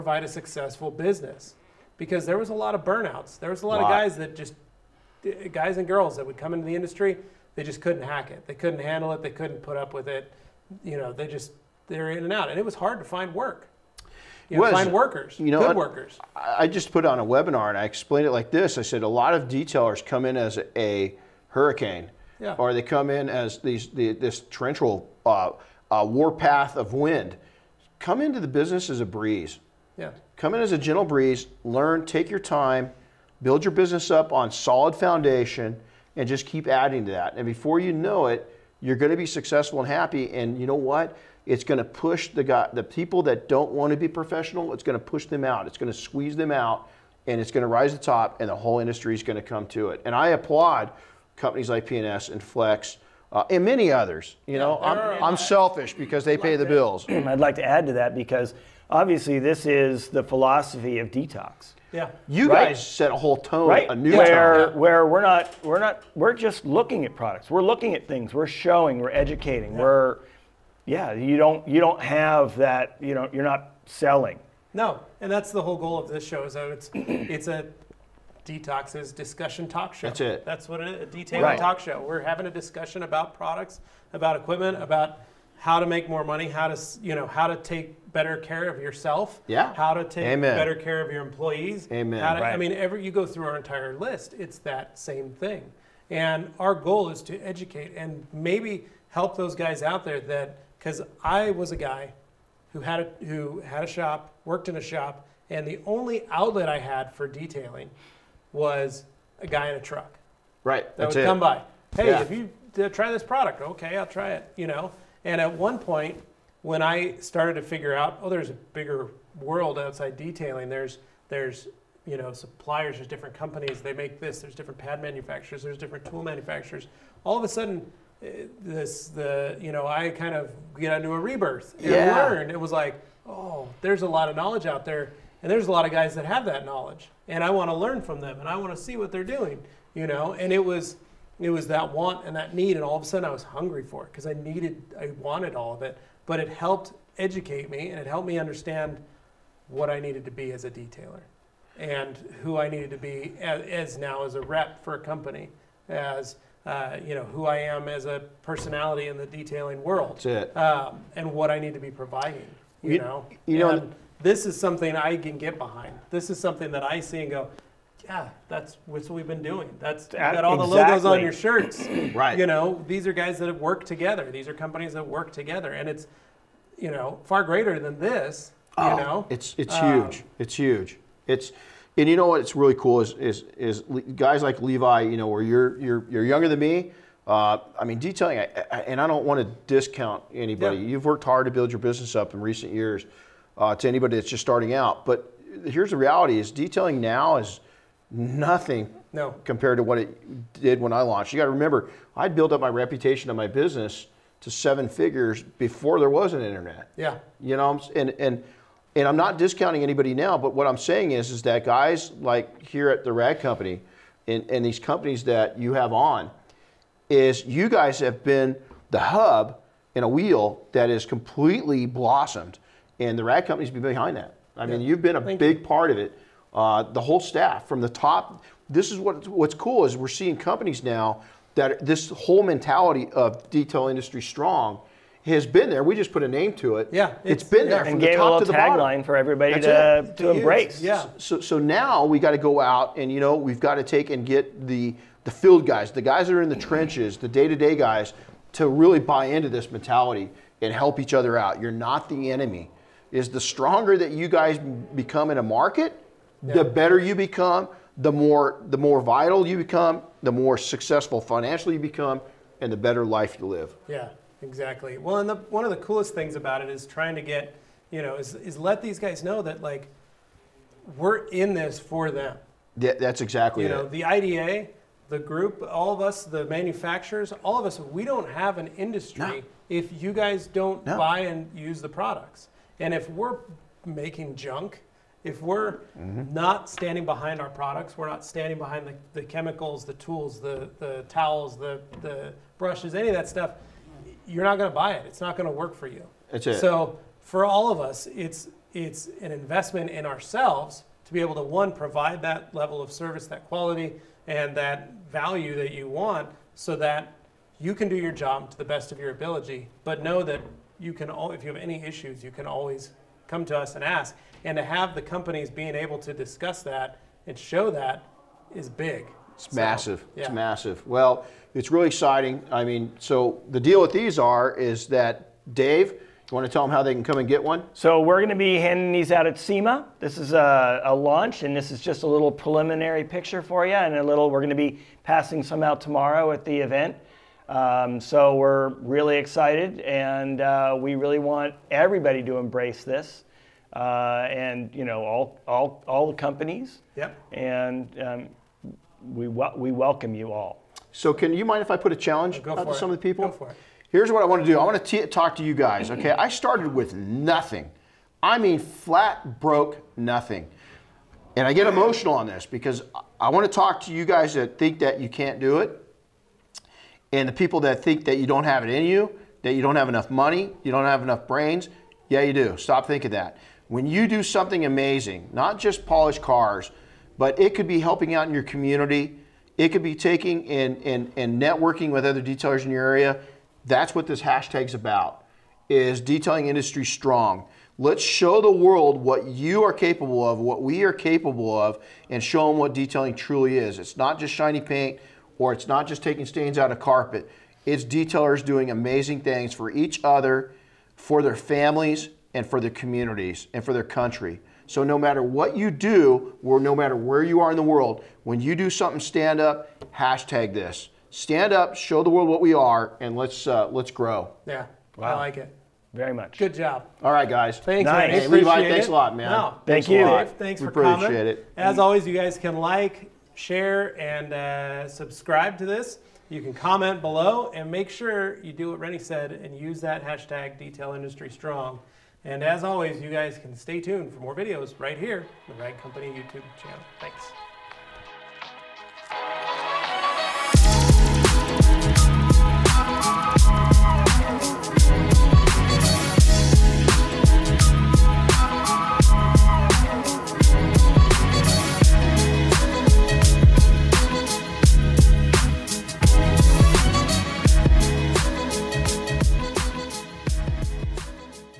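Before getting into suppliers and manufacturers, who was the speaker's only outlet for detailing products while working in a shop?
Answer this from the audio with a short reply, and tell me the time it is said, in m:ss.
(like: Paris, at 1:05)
A guy in a truck, at 1:49.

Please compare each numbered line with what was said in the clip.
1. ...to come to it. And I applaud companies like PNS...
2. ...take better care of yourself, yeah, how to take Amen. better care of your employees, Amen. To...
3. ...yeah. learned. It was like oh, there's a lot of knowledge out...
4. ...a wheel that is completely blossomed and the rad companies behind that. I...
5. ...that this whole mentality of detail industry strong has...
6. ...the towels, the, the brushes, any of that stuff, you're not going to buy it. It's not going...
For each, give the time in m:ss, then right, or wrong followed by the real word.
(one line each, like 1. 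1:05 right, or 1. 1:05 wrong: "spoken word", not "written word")
1. 0:49 right
2. 1:27 right
3. 2:11 right
4. 3:40 right
5. 3:51 right
6. 4:50 right.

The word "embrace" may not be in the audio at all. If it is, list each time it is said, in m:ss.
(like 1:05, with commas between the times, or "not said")
4:00, 5:42.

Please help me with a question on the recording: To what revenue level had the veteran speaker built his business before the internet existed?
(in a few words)
Seven figures.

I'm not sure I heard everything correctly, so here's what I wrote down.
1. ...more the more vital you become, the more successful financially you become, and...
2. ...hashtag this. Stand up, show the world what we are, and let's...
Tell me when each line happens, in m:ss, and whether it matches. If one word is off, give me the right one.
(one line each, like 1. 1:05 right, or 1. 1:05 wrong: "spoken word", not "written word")
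1. 4:18 right
2. 6:49 right.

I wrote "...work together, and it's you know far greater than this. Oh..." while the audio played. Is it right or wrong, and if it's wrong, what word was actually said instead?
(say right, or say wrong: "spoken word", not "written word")
right.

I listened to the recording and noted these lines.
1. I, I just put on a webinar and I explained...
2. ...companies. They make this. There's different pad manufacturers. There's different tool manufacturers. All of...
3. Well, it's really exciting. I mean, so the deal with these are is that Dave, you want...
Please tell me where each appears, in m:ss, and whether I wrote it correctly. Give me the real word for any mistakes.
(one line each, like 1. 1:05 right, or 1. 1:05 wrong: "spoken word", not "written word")
1. 0:16 right
2. 2:03 right
3. 5:20 right.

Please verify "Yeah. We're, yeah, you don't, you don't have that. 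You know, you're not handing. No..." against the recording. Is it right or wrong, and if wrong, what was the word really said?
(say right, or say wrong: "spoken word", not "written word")
wrong: "selling", not "handing".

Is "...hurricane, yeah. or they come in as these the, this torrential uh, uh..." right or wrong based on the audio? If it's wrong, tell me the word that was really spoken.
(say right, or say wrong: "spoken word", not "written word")
right.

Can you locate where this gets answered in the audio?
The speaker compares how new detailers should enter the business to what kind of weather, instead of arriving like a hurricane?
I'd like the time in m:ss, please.
0:30.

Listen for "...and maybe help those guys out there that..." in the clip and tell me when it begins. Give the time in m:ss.
1:37.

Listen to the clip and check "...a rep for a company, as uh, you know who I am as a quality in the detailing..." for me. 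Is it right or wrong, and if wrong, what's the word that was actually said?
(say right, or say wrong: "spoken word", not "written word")
wrong: "personality", not "quality".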